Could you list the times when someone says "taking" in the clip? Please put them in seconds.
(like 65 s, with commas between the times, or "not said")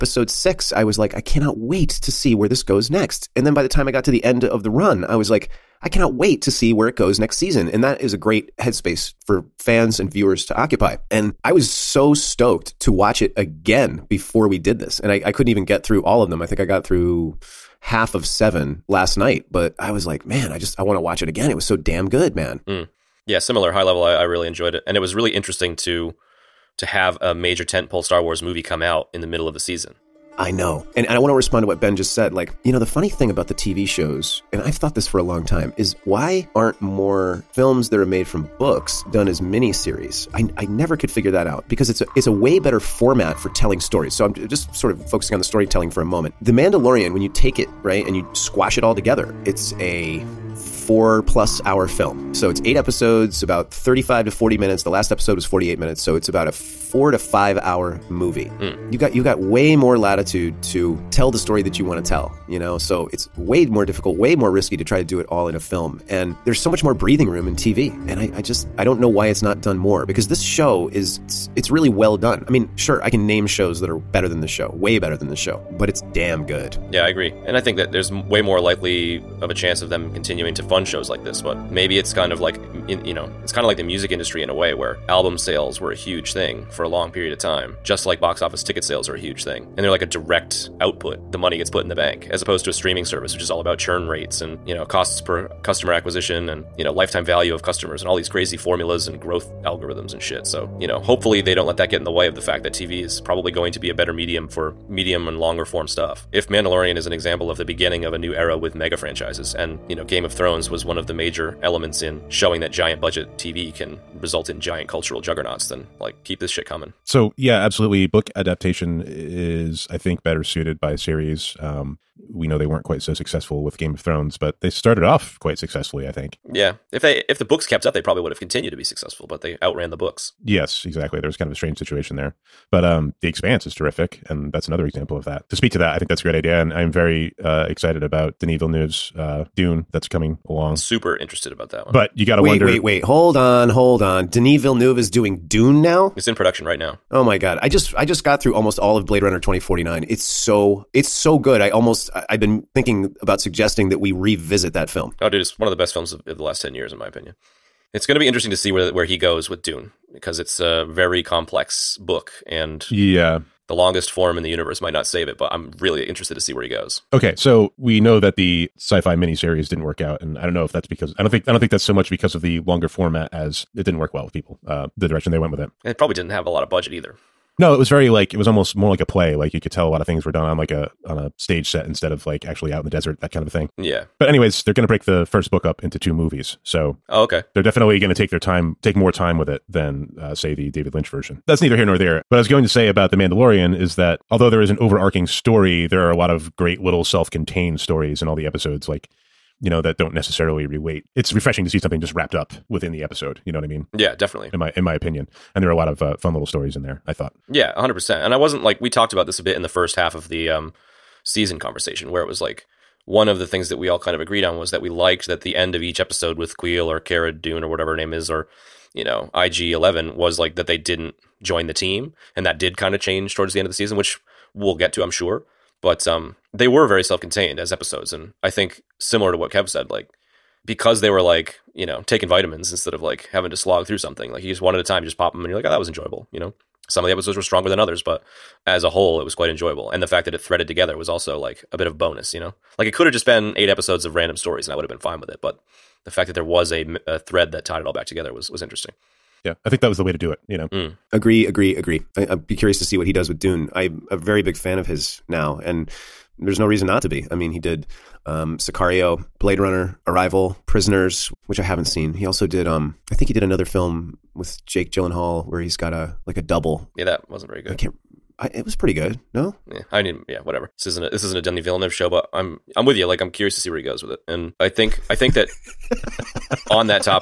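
232 s.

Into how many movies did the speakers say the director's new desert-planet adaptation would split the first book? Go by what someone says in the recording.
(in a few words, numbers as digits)
2.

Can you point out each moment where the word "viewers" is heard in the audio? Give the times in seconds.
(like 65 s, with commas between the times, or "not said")
10 s.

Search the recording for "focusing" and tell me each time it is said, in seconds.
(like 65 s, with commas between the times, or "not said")
45 s.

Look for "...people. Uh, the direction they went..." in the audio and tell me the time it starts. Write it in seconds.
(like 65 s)
174 s.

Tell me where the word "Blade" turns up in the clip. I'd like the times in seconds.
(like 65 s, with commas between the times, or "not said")
149 s, 259 s.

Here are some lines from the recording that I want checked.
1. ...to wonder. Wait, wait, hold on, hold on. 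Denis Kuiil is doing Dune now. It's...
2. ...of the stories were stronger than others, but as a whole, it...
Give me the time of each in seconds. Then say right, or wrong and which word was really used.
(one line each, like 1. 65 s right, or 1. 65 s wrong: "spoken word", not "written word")
1. 142 s wrong: "Villeneuve", not "Kuiil"
2. 237 s wrong: "episodes", not "stories".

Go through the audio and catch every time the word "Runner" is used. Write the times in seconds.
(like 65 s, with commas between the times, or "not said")
149 s, 259 s.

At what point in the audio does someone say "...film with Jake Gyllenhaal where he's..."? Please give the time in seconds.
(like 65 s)
263 s.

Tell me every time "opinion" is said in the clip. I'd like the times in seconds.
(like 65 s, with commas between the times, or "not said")
157 s, 204 s.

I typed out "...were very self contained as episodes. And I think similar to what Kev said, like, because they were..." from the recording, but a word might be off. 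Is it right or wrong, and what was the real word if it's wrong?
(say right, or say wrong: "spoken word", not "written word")
right.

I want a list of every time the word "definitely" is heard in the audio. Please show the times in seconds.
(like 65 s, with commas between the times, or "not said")
187 s, 204 s.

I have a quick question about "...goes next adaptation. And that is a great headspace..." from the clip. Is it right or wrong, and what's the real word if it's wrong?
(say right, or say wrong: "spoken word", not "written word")
wrong: "season", not "adaptation".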